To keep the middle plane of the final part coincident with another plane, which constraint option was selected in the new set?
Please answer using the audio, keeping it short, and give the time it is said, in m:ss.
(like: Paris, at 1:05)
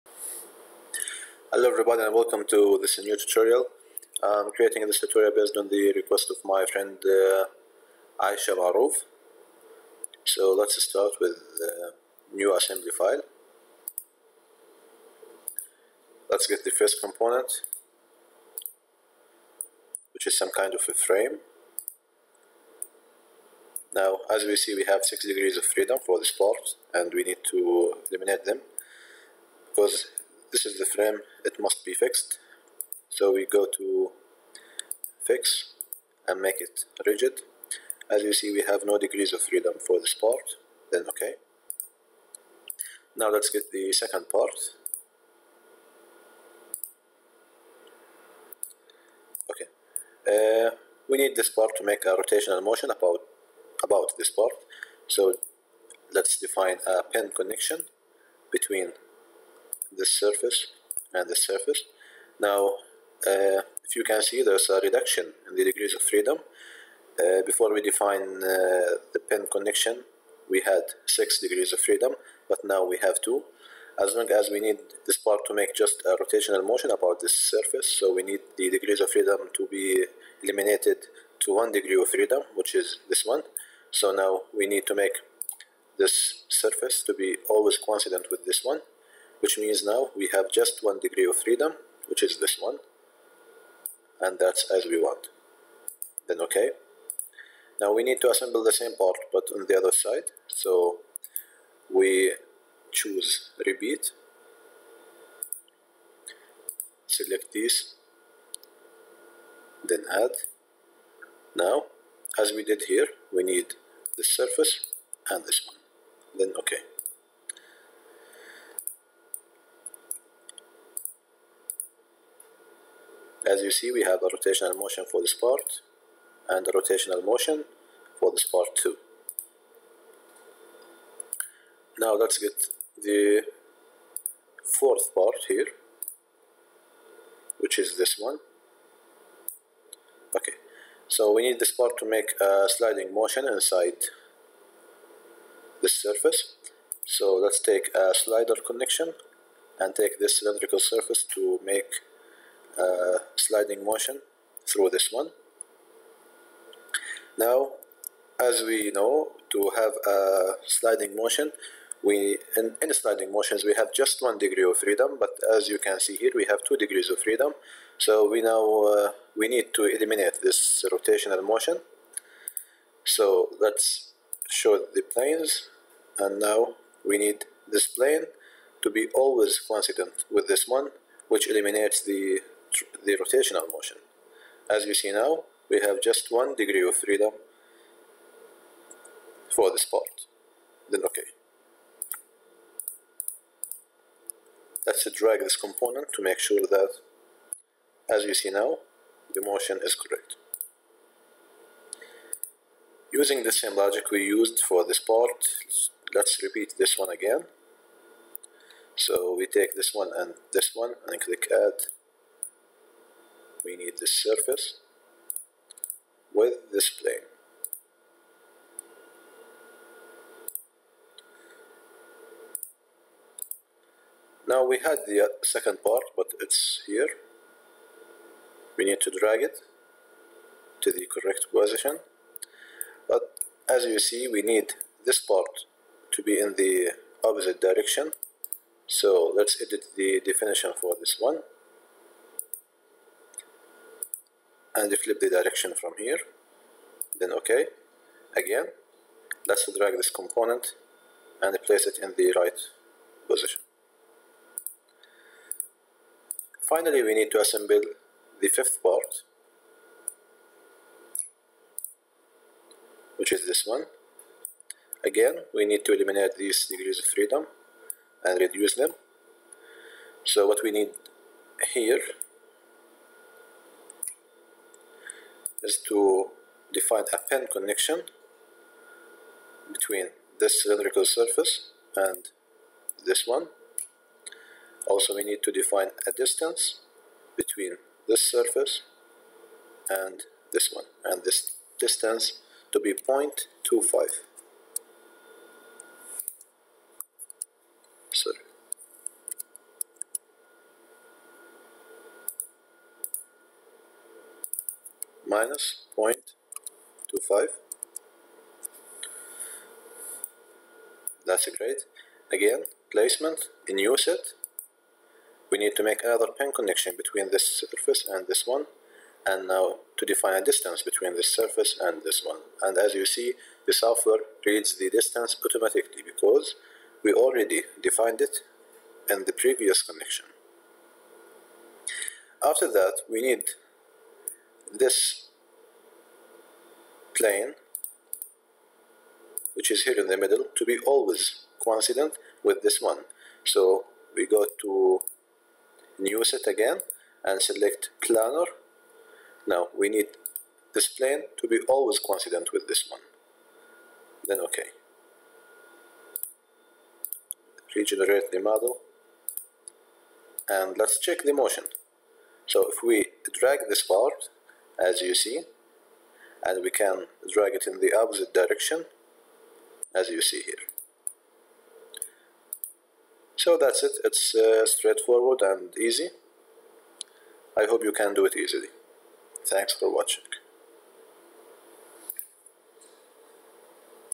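planar, at 5:48.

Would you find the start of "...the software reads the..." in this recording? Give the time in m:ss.
5:23.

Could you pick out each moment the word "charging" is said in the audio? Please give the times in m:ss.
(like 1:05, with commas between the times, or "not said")
not said.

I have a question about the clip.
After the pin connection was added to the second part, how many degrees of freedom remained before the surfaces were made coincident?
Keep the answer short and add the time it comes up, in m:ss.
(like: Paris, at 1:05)
2, at 1:13.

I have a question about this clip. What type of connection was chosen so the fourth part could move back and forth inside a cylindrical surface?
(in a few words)
slider connection.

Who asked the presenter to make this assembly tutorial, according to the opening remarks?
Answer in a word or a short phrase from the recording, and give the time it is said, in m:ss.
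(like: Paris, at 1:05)
Aisha Maruf, at 0:08.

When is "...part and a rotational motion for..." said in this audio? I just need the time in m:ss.
2:05.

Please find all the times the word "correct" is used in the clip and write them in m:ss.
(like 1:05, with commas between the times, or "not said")
3:19, 3:51.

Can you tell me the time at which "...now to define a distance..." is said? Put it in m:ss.
5:19.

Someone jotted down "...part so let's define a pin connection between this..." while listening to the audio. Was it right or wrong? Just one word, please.
right.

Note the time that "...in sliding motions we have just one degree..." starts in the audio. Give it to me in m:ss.
2:42.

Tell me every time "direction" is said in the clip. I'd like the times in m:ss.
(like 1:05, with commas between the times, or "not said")
3:57, 4:05, 6:08.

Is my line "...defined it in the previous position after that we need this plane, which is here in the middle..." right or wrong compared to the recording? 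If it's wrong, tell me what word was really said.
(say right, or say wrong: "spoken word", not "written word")
wrong: "connection", not "position".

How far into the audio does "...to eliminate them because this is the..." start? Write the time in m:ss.
0:27.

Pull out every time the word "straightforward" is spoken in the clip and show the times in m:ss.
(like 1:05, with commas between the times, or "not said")
6:14.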